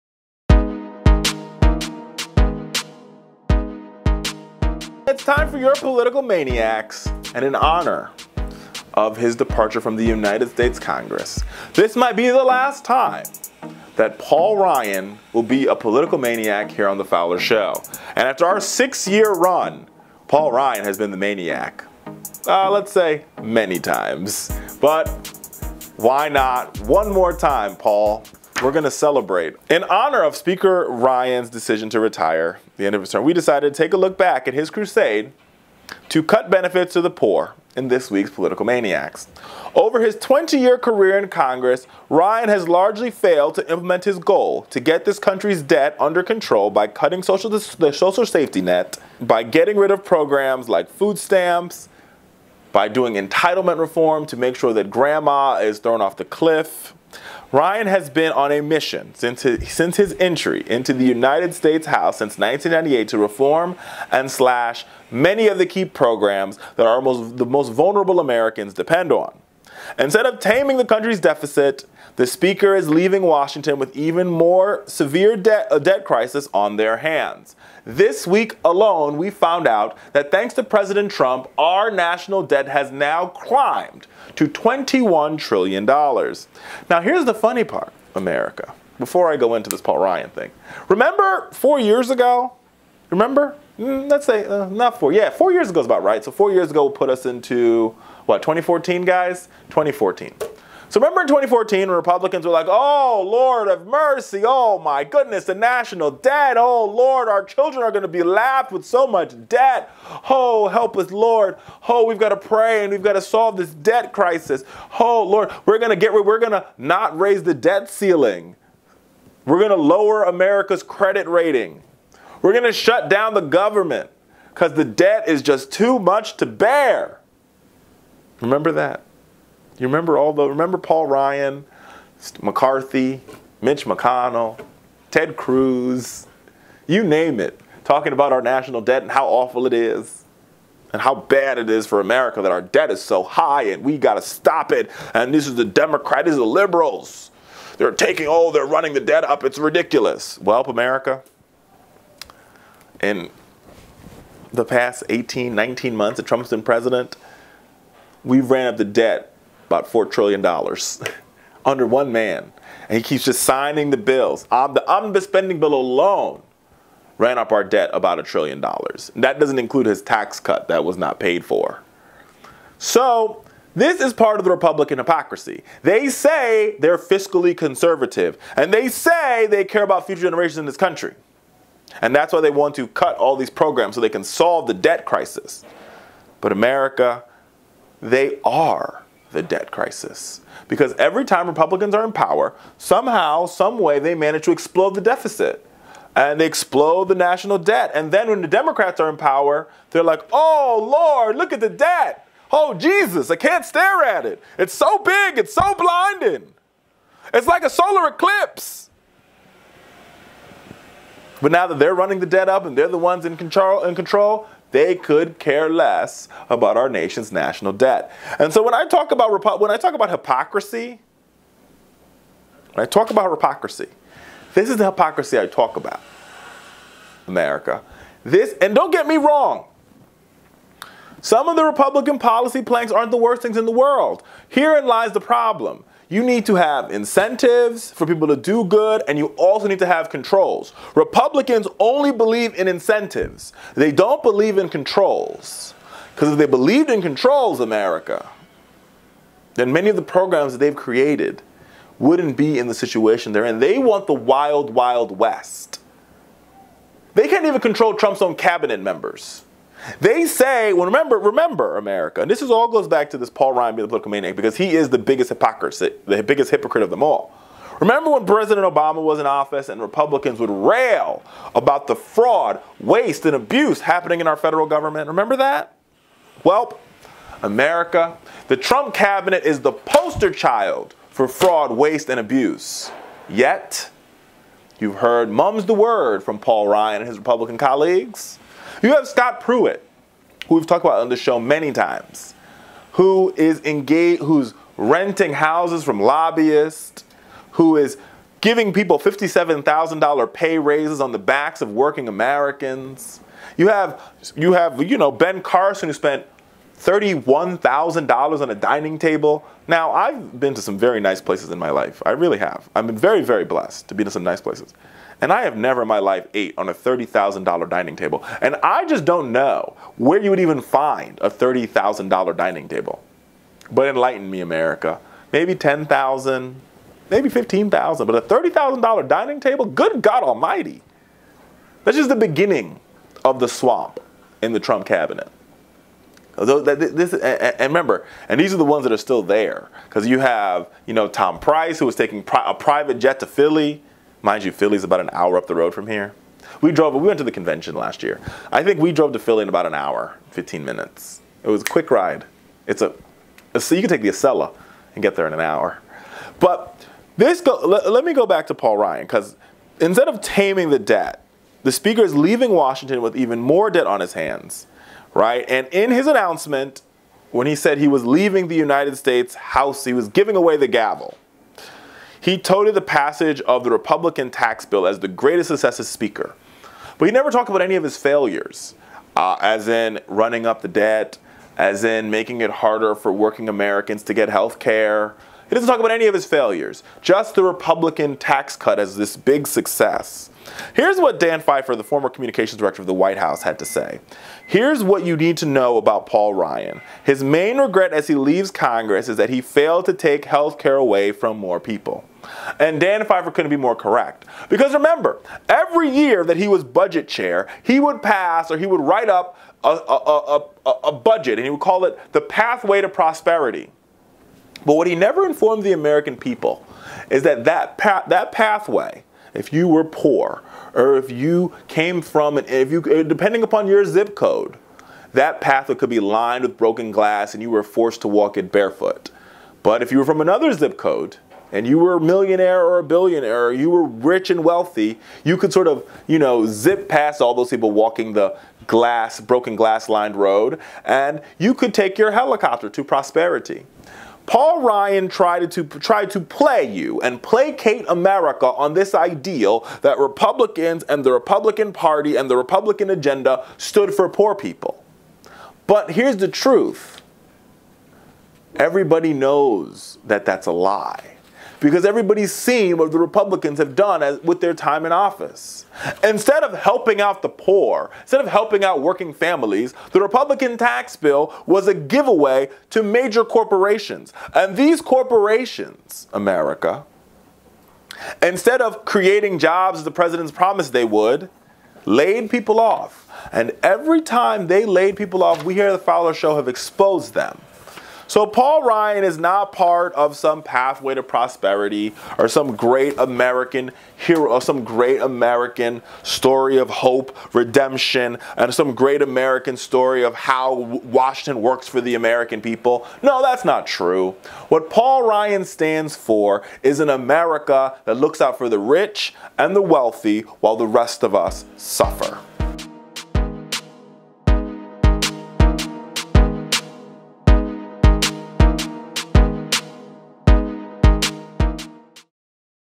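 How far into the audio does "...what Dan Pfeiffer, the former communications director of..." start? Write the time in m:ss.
6:30.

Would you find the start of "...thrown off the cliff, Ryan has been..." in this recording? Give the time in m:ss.
0:55.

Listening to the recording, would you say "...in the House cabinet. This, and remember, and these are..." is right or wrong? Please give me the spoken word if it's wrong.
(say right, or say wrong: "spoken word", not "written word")
wrong: "Trump", not "House".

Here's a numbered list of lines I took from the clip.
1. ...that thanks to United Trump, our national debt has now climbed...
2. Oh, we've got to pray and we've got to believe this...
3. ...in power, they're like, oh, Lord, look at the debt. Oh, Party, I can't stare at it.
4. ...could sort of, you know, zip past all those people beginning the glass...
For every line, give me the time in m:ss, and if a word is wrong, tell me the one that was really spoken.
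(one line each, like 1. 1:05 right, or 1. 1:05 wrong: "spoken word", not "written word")
1. 1:20 wrong: "President", not "United"
2. 1:51 wrong: "solve", not "believe"
3. 3:19 wrong: "Jesus", not "Party"
4. 7:15 wrong: "walking", not "beginning".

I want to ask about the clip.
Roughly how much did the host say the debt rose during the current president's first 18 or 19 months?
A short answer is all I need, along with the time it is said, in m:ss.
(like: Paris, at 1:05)
$4 trillion, at 2:39.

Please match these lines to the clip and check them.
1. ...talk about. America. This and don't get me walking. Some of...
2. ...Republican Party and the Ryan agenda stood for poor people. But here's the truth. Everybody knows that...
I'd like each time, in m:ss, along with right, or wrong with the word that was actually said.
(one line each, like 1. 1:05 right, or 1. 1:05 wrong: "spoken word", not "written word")
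1. 3:45 wrong: "wrong", not "walking"
2. 7:31 wrong: "Republican", not "Ryan".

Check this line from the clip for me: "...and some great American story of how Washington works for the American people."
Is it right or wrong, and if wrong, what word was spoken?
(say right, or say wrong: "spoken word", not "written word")
right.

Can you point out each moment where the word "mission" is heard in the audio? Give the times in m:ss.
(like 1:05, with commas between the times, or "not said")
0:58.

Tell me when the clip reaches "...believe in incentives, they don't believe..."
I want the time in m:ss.
4:02.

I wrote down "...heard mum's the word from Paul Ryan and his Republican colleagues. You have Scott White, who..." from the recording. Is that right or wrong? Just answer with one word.
wrong.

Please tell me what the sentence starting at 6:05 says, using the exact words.
And in his announcement, when he said he was leaving the United States House, he was giving away the gavel.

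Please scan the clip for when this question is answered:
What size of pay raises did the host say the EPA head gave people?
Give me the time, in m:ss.
4:58.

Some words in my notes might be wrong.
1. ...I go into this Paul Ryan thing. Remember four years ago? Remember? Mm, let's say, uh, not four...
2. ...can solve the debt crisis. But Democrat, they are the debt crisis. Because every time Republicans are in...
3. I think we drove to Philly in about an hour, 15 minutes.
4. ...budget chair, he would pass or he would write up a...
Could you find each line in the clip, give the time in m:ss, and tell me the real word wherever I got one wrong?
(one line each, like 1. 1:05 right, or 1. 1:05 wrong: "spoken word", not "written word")
1. 1:29 right
2. 3:04 wrong: "America", not "Democrat"
3. 5:48 right
4. 6:46 right.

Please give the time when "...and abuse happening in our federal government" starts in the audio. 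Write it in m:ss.
4:33.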